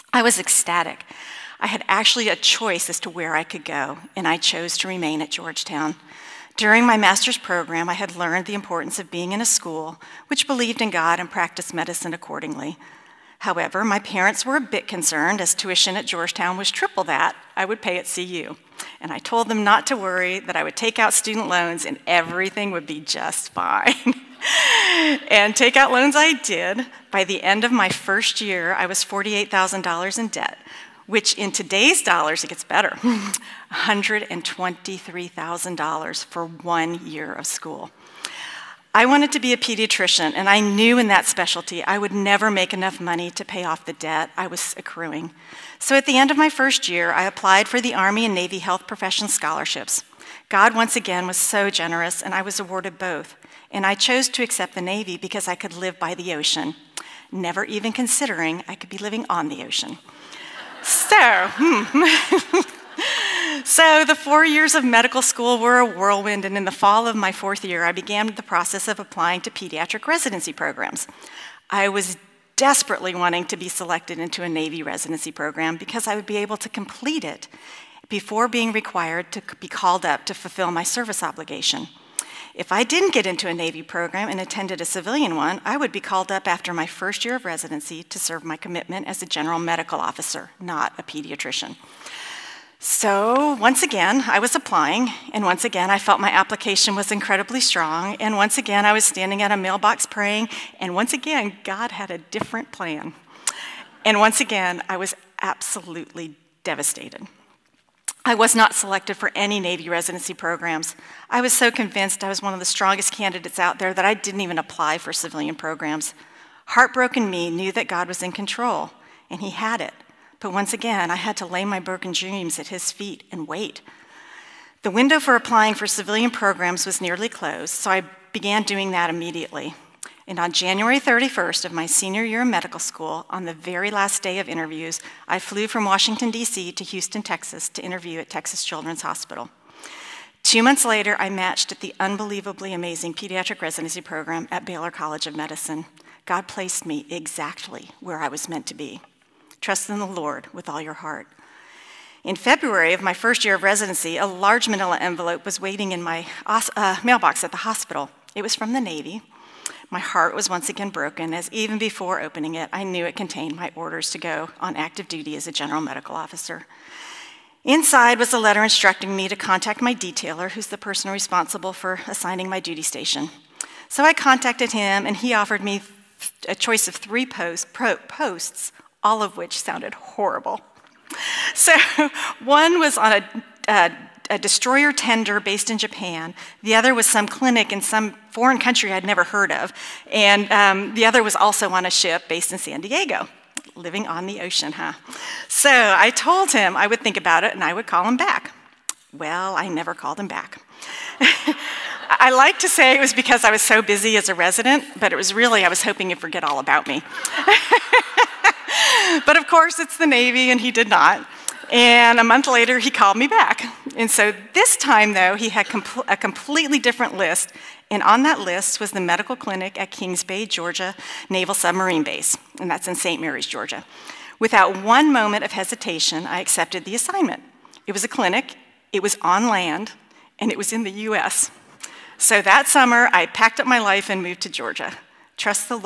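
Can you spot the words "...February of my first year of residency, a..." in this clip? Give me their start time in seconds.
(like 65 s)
152 s.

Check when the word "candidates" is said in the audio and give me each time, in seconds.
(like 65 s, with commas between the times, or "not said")
113 s.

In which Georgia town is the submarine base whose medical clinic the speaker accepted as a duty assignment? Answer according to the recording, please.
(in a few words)
St. Mary's.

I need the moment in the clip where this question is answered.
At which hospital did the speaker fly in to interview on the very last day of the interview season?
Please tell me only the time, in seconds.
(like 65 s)
138 s.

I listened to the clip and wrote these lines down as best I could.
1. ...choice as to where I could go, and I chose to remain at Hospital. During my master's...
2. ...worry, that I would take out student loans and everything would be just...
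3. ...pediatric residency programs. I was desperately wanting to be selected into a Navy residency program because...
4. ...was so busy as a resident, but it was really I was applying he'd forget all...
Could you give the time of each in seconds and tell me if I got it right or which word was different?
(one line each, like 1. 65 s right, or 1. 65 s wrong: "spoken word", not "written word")
1. 2 s wrong: "Georgetown", not "Hospital"
2. 19 s right
3. 69 s right
4. 203 s wrong: "hoping", not "applying".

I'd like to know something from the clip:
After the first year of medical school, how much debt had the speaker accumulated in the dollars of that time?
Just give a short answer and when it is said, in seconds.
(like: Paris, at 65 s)
$48,000, at 29 s.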